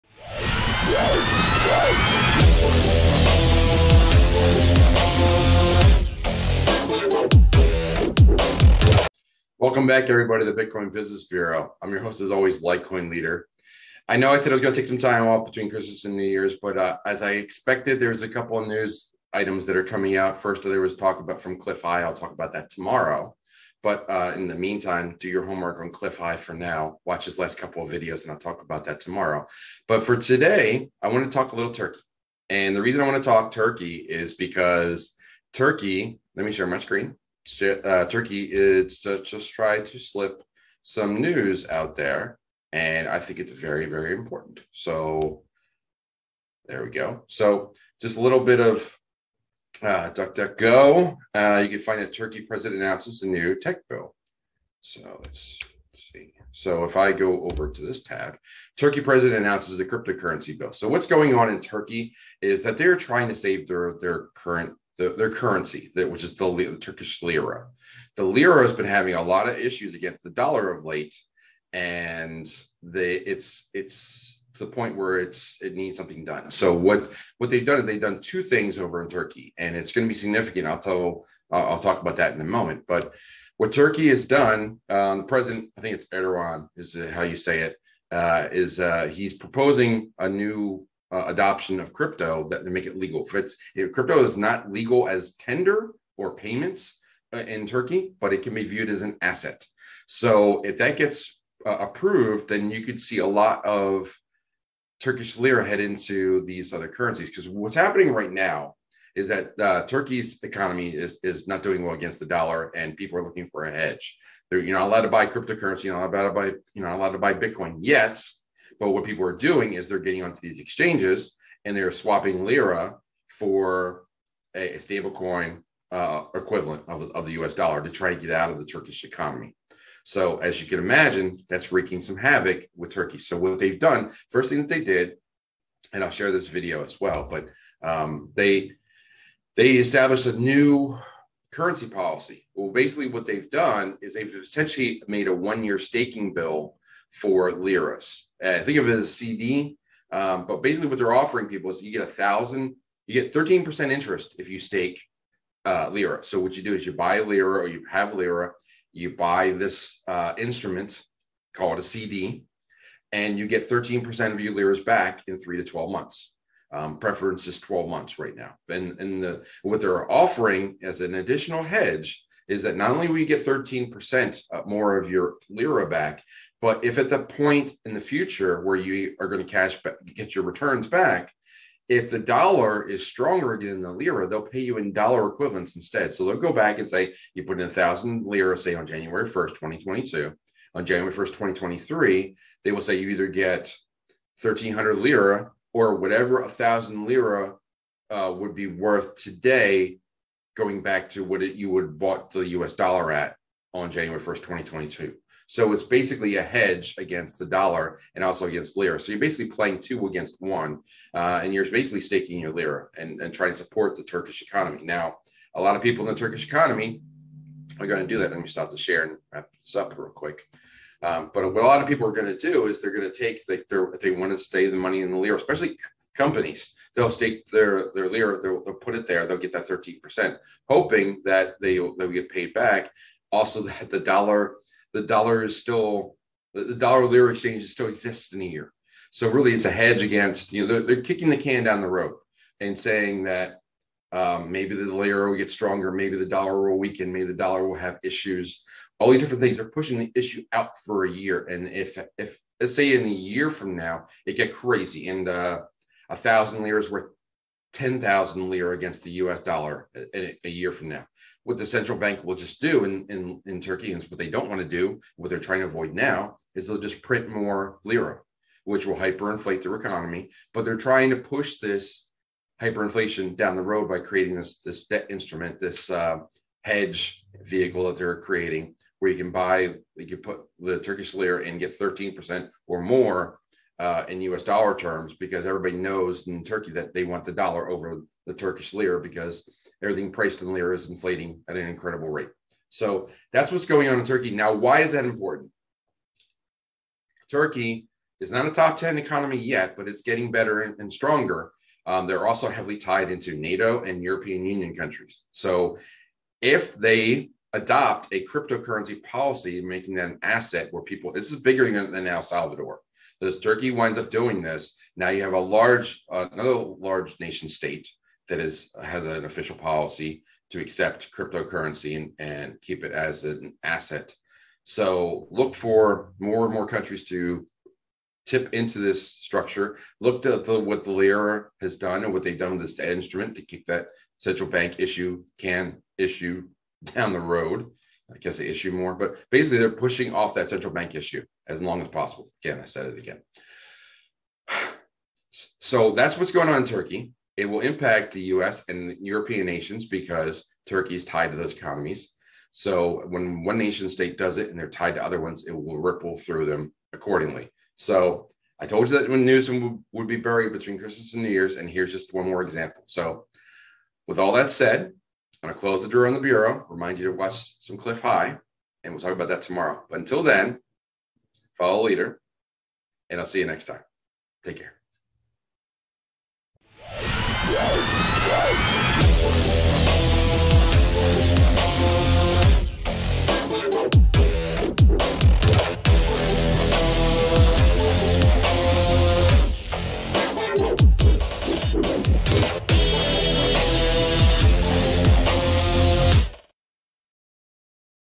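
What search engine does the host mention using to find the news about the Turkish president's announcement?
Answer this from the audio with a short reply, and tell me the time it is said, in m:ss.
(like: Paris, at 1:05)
DuckDuckGo, at 0:50.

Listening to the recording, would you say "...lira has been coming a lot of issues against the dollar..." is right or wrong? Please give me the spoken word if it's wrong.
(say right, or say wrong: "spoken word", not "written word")
wrong: "having", not "coming".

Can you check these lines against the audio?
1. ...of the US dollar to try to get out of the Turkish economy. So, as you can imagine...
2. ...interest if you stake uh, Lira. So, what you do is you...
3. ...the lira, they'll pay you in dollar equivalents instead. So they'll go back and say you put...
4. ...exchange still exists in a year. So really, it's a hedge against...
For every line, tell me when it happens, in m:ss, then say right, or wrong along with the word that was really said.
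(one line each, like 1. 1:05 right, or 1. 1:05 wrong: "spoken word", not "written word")
1. 2:07 right
2. 2:33 right
3. 3:03 right
4. 3:57 right.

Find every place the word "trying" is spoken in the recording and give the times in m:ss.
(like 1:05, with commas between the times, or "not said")
1:02, 3:33, 4:25, 4:30.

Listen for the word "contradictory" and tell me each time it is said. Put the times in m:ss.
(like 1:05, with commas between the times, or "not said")
not said.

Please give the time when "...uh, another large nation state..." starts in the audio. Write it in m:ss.
5:16.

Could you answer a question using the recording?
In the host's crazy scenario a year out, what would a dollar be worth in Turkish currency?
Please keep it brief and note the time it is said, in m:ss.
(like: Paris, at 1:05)
10,000 lira, at 4:17.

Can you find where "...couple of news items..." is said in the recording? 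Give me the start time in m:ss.
0:18.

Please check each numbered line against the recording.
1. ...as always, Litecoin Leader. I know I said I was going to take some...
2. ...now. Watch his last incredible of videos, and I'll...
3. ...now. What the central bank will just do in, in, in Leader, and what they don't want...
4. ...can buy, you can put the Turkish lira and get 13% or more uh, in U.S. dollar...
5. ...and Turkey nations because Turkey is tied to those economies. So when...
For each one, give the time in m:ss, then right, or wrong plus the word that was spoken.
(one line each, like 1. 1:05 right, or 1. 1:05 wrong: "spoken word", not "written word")
1. 0:12 right
2. 0:26 wrong: "couple", not "incredible"
3. 4:20 wrong: "Turkey", not "Leader"
4. 4:39 right
5. 5:48 wrong: "European", not "Turkey".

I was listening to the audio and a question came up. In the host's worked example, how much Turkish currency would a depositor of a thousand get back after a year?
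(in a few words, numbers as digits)
1300 lira.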